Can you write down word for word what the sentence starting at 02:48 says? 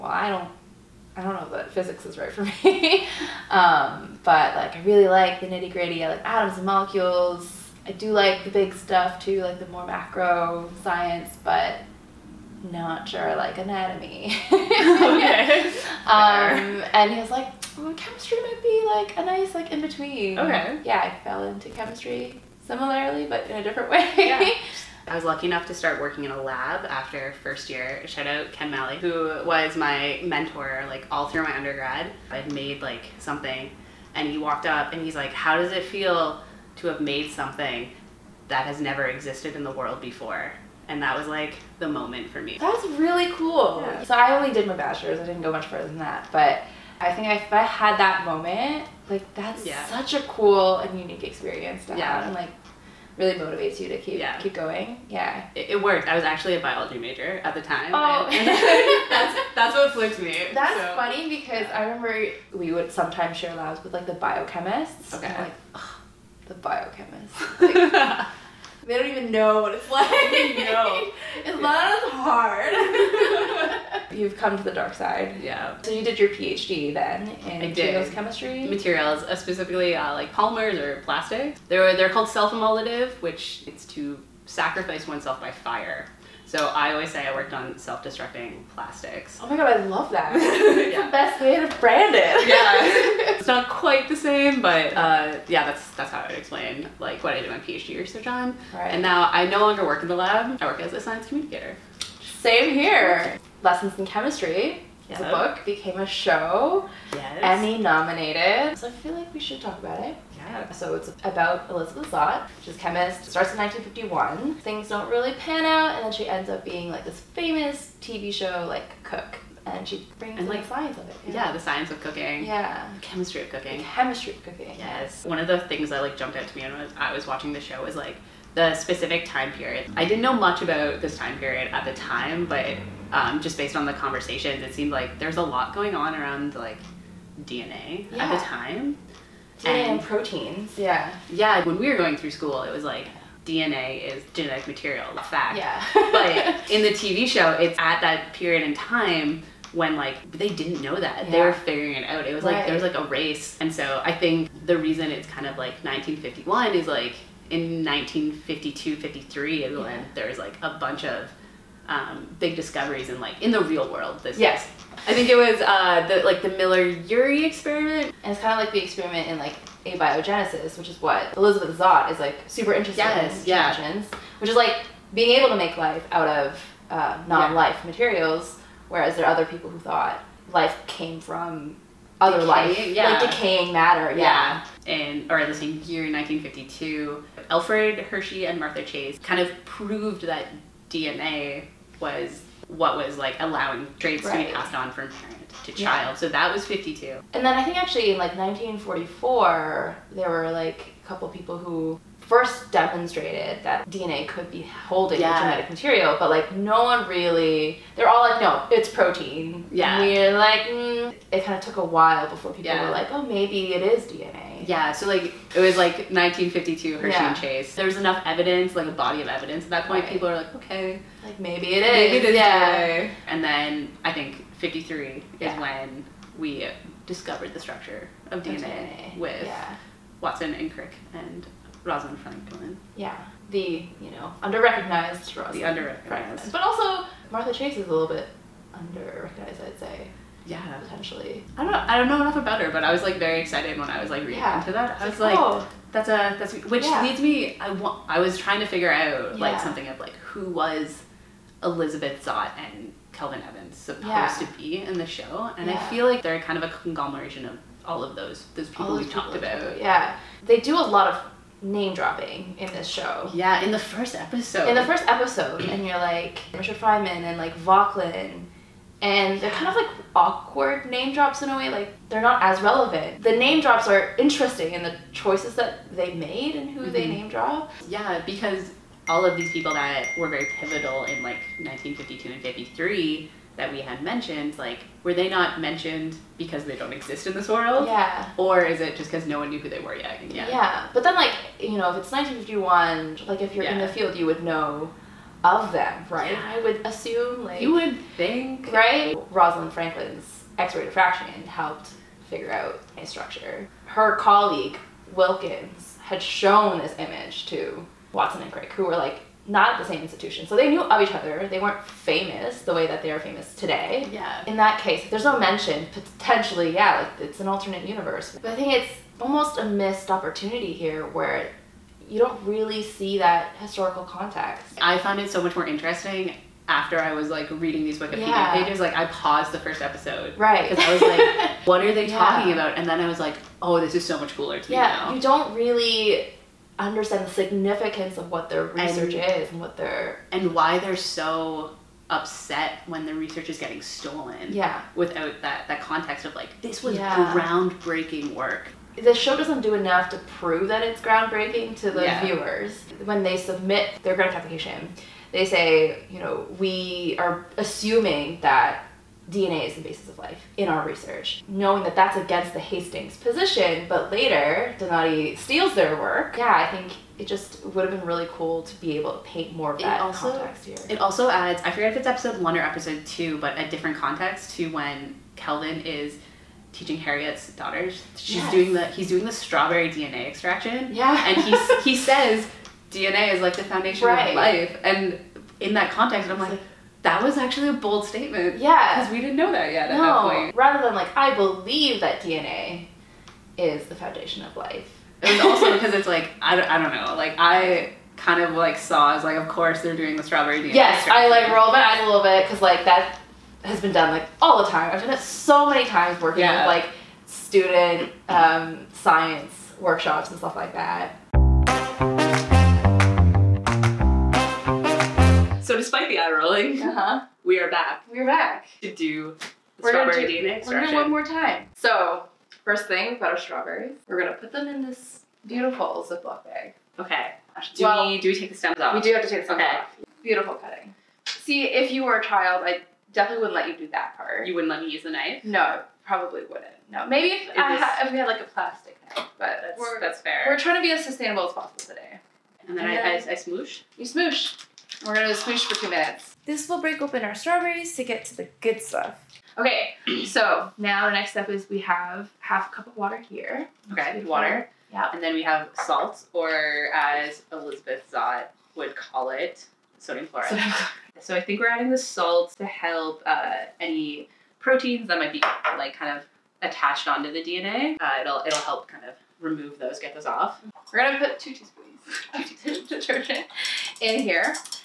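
And it's kind of like the experiment in like abiogenesis, which is what Elizabeth Zott is like super interested yes, in.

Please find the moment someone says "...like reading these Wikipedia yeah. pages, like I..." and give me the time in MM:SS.
05:27.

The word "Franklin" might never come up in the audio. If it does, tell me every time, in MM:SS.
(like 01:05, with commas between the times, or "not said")
03:52, 04:59.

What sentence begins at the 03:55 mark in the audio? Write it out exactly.
The underrecognized, recognized but also Martha Chase is a little bit underrecognized, I'd say.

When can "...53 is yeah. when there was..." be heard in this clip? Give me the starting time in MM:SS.
02:38.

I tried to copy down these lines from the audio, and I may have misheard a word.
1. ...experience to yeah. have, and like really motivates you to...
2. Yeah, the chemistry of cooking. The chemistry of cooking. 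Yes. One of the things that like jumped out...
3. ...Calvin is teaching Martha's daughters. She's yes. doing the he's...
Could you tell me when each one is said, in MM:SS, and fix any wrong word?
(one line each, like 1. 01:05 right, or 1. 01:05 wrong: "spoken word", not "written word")
1. 00:51 right
2. 02:02 right
3. 06:15 wrong: "Harriet", not "Martha".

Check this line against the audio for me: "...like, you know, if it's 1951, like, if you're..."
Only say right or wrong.
right.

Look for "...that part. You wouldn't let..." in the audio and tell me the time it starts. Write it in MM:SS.
07:13.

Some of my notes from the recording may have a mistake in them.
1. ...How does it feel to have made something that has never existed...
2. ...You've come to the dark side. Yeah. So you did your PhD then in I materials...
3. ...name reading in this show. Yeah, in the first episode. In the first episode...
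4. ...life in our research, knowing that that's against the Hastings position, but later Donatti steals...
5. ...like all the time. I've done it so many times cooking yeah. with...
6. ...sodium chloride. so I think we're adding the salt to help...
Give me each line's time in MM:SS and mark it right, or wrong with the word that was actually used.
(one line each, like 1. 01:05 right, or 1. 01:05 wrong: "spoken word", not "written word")
1. 00:35 right
2. 01:14 right
3. 04:21 wrong: "dropping", not "reading"
4. 06:00 right
5. 06:44 wrong: "working", not "cooking"
6. 07:39 right.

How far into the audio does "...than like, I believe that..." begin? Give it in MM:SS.
06:30.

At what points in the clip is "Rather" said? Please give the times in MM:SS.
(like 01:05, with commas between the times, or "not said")
06:30.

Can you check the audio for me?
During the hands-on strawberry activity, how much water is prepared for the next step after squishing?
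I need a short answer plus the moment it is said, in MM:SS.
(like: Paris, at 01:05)
half a cup, at 07:32.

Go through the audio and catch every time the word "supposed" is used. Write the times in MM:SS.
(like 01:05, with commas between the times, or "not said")
04:13.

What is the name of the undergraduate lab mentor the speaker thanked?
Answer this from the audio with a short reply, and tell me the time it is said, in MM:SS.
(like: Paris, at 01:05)
Ken Malley, at 00:28.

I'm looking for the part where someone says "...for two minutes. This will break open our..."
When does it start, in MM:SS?
07:25.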